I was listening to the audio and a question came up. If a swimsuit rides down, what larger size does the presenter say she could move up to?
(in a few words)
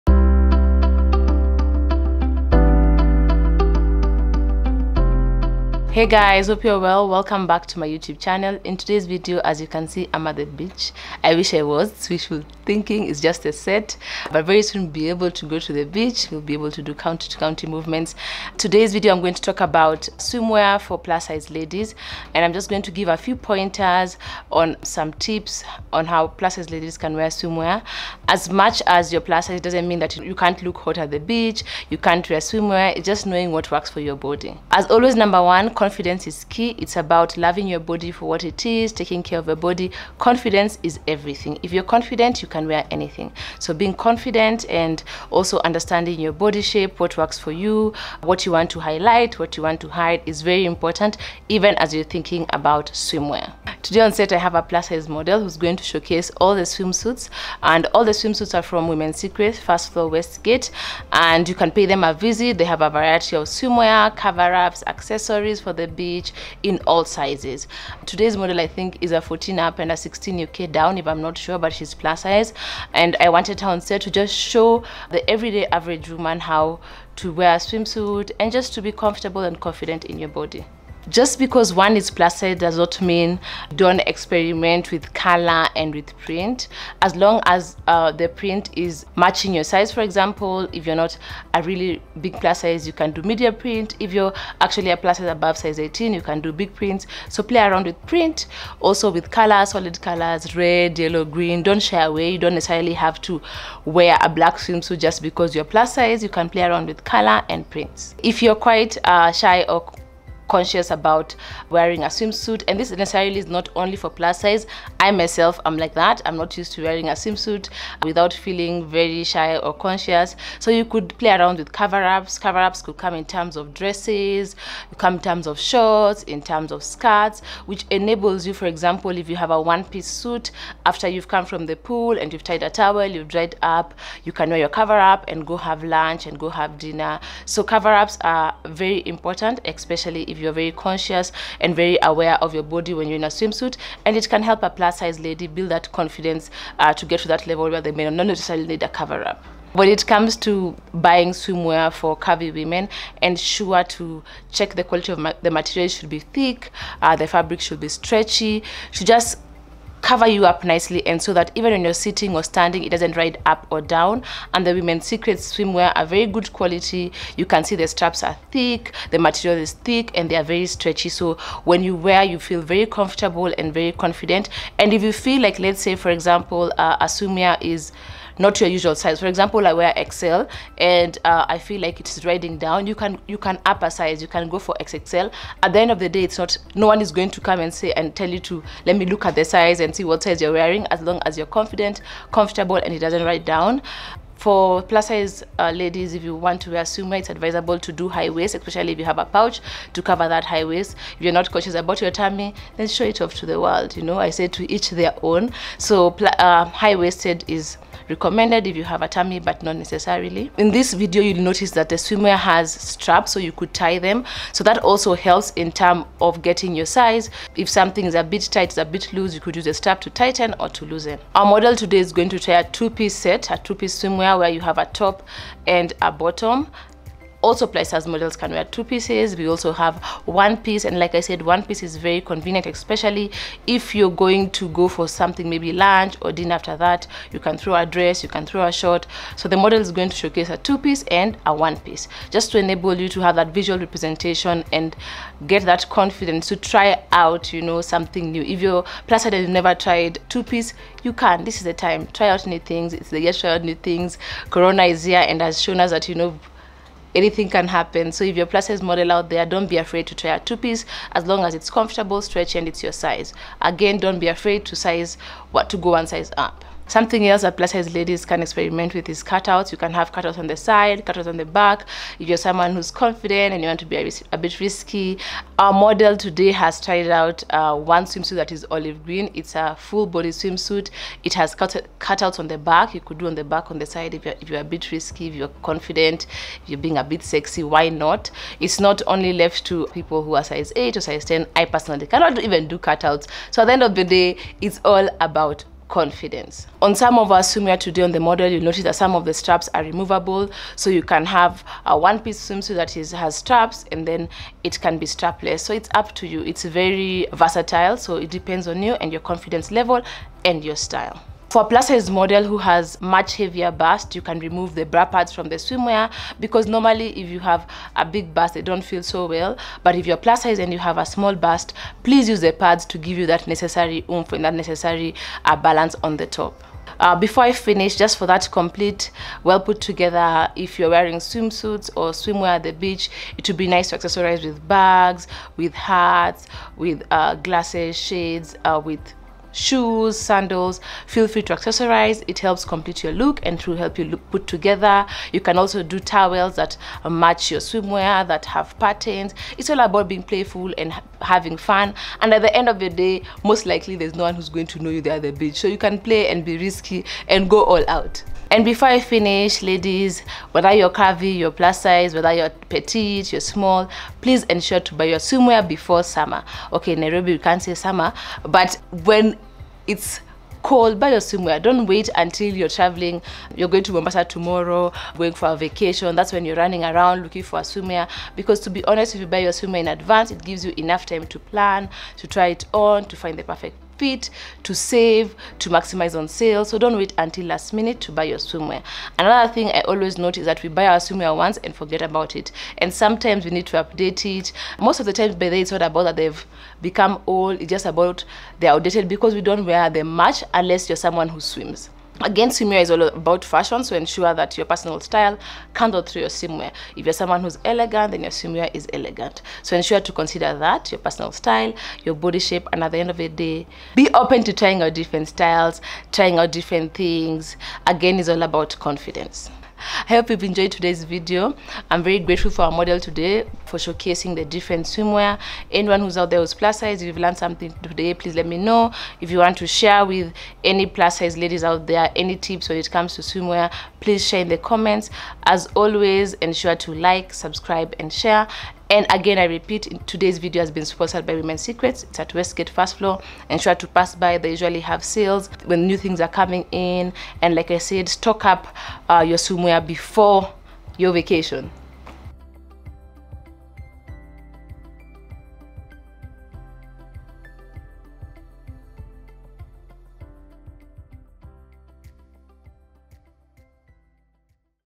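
XXL.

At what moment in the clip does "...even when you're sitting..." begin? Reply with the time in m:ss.
2:41.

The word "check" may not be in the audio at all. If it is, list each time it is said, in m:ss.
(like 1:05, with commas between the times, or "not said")
2:34.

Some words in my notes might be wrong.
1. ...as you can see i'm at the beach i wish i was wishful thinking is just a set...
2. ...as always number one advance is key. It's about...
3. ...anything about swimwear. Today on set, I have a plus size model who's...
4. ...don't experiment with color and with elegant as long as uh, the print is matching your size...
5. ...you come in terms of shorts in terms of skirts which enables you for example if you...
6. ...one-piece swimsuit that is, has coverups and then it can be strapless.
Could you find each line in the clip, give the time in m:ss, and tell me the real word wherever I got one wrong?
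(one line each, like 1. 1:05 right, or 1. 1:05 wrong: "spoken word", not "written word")
1. 0:09 right
2. 0:34 wrong: "confidence", not "advance"
3. 0:52 wrong: "thinking", not "anything"
4. 1:23 wrong: "print", not "elegant"
5. 2:04 right
6. 5:01 wrong: "straps", not "coverups".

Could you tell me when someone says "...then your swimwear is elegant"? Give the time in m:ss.
6:48.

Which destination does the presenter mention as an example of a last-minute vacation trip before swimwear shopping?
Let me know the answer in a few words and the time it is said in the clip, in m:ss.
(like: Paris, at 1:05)
Mombasa, at 6:13.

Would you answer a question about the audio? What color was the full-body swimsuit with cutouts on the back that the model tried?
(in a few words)
Olive green.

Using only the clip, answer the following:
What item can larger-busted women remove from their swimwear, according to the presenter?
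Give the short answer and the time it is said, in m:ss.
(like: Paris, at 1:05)
Bra pads, at 5:14.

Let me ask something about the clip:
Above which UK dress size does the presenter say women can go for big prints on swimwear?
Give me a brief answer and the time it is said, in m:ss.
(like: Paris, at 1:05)
18, at 1:35.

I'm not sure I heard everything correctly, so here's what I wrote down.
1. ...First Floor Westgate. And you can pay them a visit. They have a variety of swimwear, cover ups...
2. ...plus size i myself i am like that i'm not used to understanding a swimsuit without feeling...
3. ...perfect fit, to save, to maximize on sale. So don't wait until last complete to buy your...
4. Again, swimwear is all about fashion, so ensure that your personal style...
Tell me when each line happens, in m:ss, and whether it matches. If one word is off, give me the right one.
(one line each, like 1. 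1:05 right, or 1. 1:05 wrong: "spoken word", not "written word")
1. 0:59 right
2. 1:54 wrong: "wearing", not "understanding"
3. 6:23 wrong: "minute", not "complete"
4. 6:42 right.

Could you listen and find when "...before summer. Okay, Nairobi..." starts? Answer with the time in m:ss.
6:05.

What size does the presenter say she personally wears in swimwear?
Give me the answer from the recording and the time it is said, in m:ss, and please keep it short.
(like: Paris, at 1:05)
XL, at 3:00.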